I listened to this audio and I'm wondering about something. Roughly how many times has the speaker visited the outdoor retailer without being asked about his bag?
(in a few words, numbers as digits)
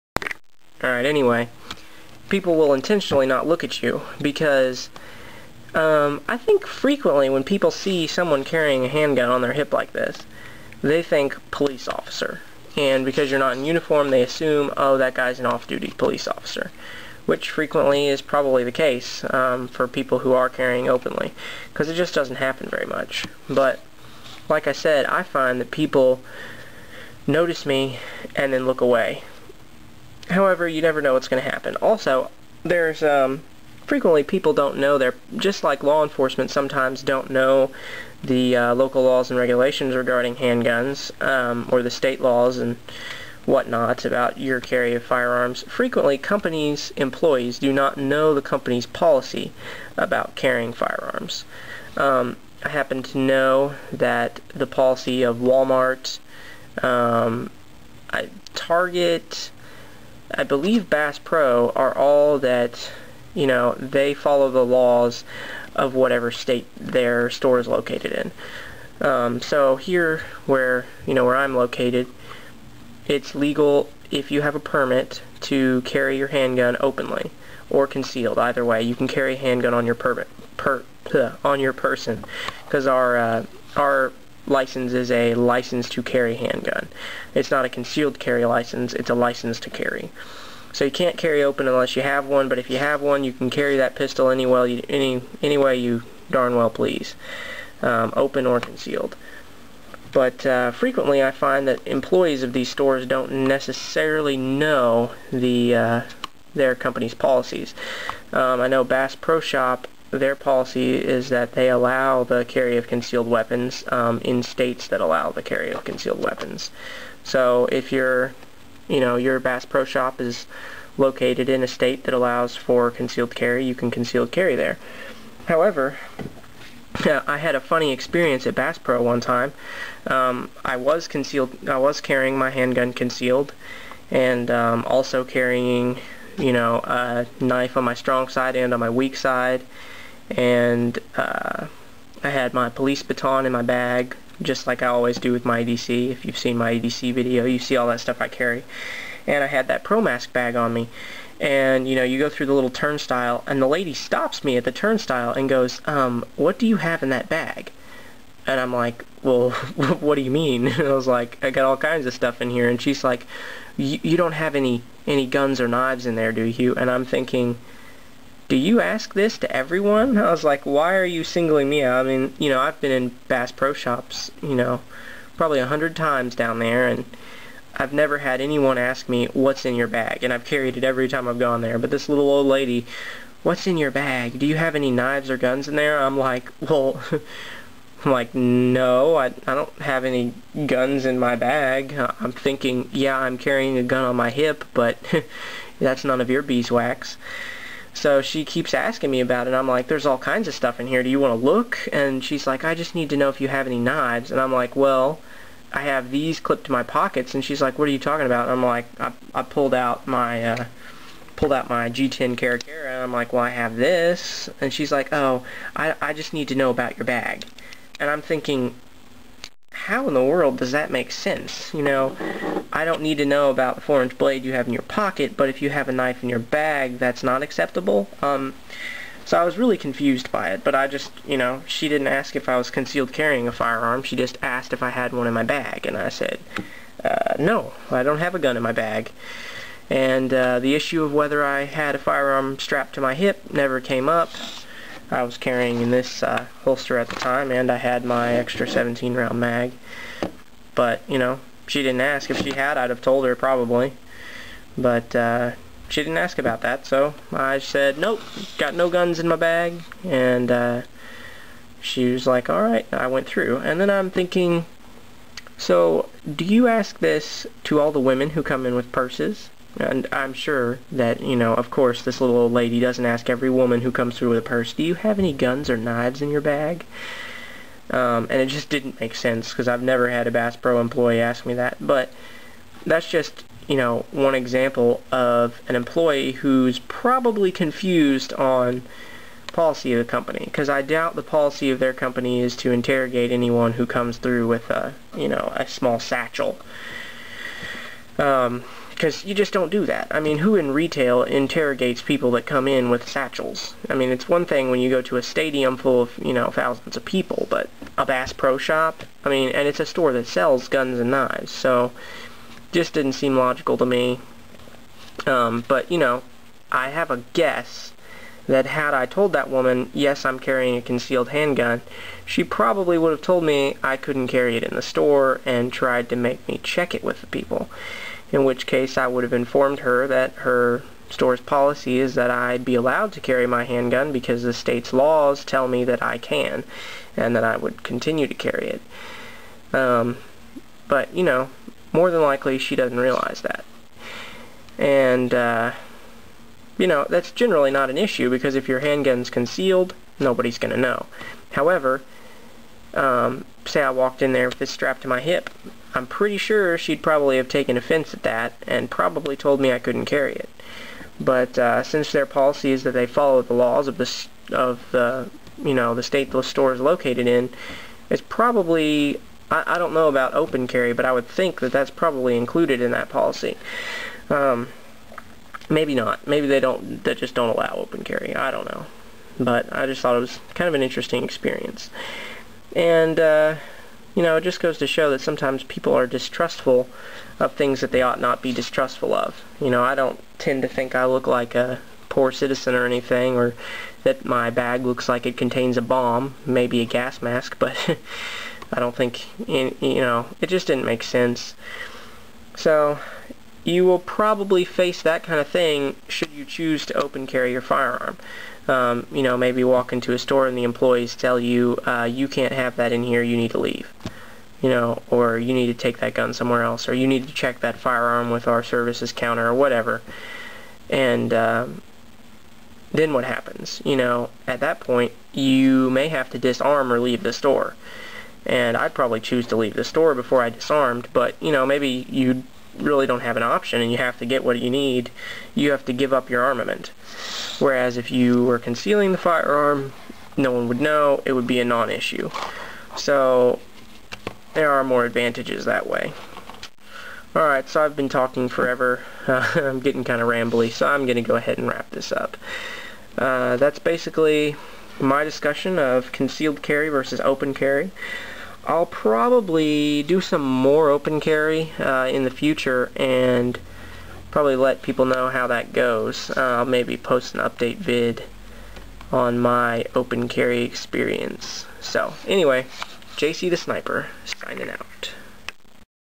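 100.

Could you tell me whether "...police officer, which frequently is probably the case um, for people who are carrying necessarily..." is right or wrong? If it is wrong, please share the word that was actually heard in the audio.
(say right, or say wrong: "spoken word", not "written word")
wrong: "openly", not "necessarily".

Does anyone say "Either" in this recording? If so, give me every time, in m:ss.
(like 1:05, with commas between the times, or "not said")
1:18.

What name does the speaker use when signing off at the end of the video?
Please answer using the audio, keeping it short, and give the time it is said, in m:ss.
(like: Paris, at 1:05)
JC the Sniper, at 7:53.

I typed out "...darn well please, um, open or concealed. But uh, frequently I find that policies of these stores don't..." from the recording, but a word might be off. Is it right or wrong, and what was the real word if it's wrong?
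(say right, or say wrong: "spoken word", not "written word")
wrong: "employees", not "policies".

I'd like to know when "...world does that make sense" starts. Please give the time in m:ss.
3:40.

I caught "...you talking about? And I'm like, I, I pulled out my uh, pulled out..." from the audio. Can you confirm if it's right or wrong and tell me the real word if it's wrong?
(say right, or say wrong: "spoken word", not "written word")
right.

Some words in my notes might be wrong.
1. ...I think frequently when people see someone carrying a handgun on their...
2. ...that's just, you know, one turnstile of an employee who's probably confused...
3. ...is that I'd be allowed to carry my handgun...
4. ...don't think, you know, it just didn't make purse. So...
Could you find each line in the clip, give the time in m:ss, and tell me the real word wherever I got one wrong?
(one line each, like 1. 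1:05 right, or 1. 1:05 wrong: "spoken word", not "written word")
1. 0:06 right
2. 4:42 wrong: "example", not "turnstile"
3. 5:31 right
4. 6:38 wrong: "sense", not "purse".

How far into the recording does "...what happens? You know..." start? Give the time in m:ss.
7:03.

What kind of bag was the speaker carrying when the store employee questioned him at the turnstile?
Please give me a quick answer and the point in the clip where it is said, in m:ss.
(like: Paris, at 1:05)
Pro Mask bag, at 2:29.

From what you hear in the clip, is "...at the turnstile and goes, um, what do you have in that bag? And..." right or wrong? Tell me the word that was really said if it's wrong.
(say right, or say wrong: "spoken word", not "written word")
right.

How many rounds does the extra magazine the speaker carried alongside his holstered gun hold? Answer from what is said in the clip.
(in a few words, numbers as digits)
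17.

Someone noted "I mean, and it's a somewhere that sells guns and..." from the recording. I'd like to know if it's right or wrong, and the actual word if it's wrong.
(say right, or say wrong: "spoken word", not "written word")
wrong: "store", not "somewhere".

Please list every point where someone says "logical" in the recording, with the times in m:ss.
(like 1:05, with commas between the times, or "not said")
5:13.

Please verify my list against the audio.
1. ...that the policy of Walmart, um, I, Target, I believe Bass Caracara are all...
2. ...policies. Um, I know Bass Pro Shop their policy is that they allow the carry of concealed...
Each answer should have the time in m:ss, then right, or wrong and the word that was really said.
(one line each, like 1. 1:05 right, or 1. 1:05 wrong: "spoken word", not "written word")
1. 0:53 wrong: "Pro", not "Caracara"
2. 1:47 right.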